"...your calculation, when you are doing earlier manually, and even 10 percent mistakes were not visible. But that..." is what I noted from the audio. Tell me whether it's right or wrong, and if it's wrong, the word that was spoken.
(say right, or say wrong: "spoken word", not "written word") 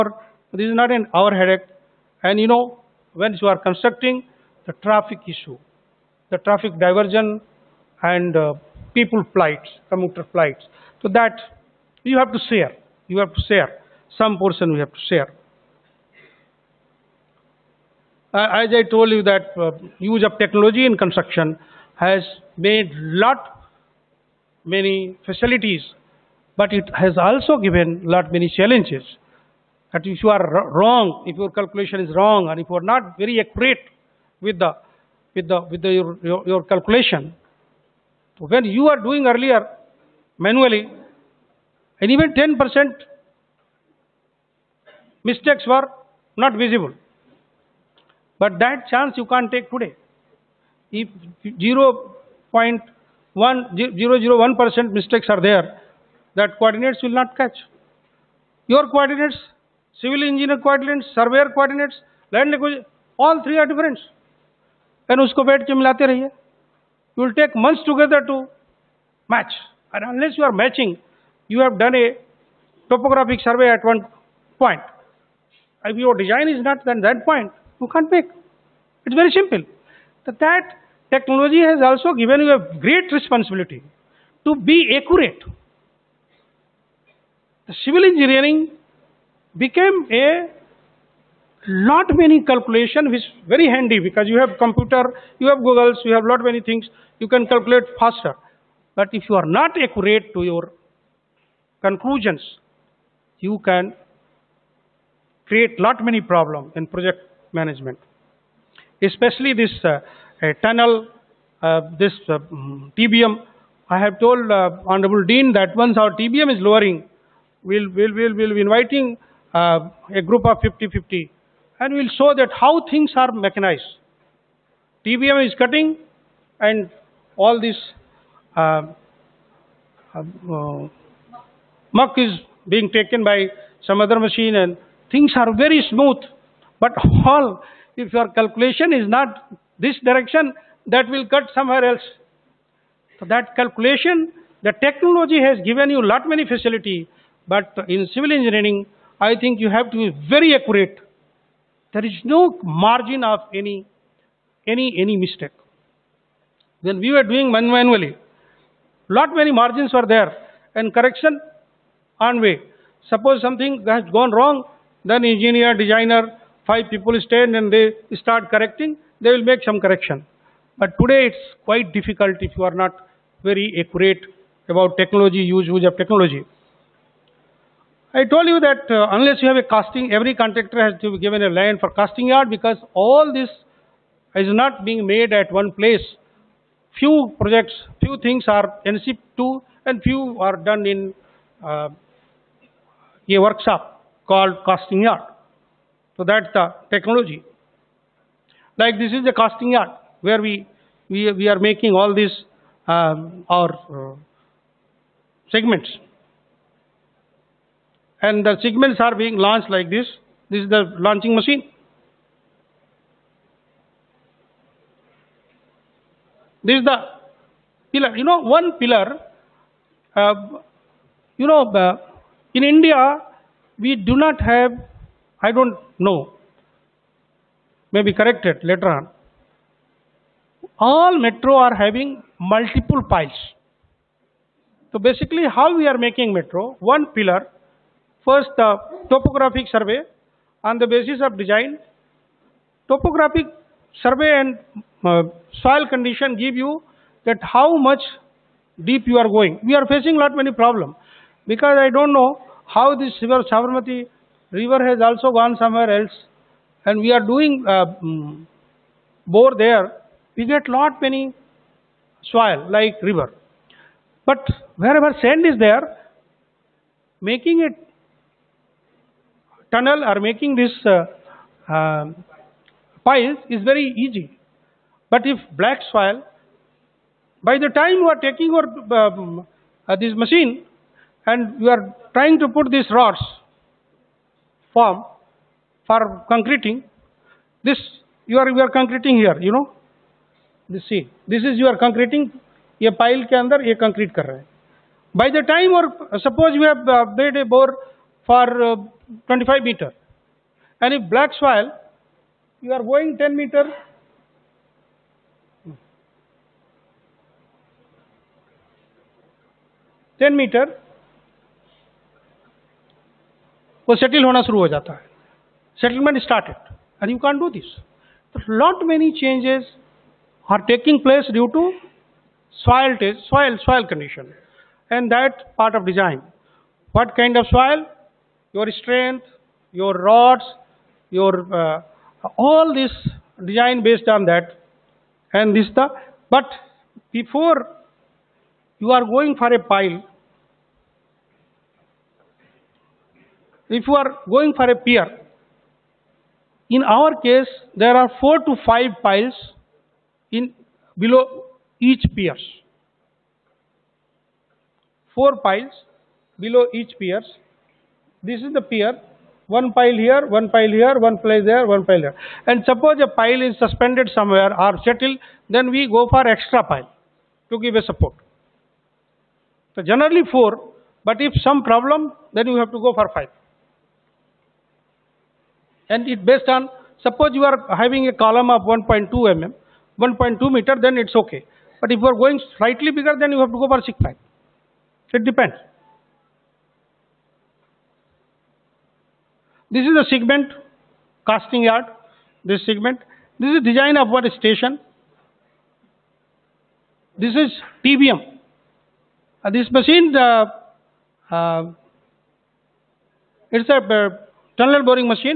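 right.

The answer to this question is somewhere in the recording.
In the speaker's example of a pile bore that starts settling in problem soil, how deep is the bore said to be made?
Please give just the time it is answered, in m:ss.
4:59.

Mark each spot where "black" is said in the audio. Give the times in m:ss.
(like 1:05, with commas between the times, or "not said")
4:35, 5:01.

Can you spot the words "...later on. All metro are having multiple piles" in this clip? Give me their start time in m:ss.
3:48.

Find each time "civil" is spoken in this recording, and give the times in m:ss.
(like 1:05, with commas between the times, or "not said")
0:59, 1:27, 2:28.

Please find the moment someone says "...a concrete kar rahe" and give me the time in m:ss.
4:53.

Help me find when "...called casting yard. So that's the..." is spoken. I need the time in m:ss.
3:14.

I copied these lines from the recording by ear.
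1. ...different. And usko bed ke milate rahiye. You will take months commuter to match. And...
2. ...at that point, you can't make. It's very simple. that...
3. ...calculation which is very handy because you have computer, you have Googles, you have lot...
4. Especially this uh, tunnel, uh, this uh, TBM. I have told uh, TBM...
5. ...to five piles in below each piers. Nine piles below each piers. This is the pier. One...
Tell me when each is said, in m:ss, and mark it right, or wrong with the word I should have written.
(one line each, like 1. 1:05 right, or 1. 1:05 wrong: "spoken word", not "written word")
1. 1:03 wrong: "together", not "commuter"
2. 1:16 right
3. 1:32 right
4. 1:49 wrong: "Honorable", not "TBM"
5. 5:48 wrong: "Four", not "Nine".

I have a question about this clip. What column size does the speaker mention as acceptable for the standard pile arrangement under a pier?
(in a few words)
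1.2 meters.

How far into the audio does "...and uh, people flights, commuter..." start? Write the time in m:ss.
0:08.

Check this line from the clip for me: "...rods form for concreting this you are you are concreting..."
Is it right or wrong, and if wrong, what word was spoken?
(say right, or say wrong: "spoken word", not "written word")
right.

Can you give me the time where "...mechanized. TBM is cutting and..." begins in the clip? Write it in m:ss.
2:03.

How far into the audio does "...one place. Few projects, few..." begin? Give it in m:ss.
3:05.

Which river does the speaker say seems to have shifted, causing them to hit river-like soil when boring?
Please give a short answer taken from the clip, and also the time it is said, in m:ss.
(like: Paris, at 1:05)
Sabarmati, at 4:13.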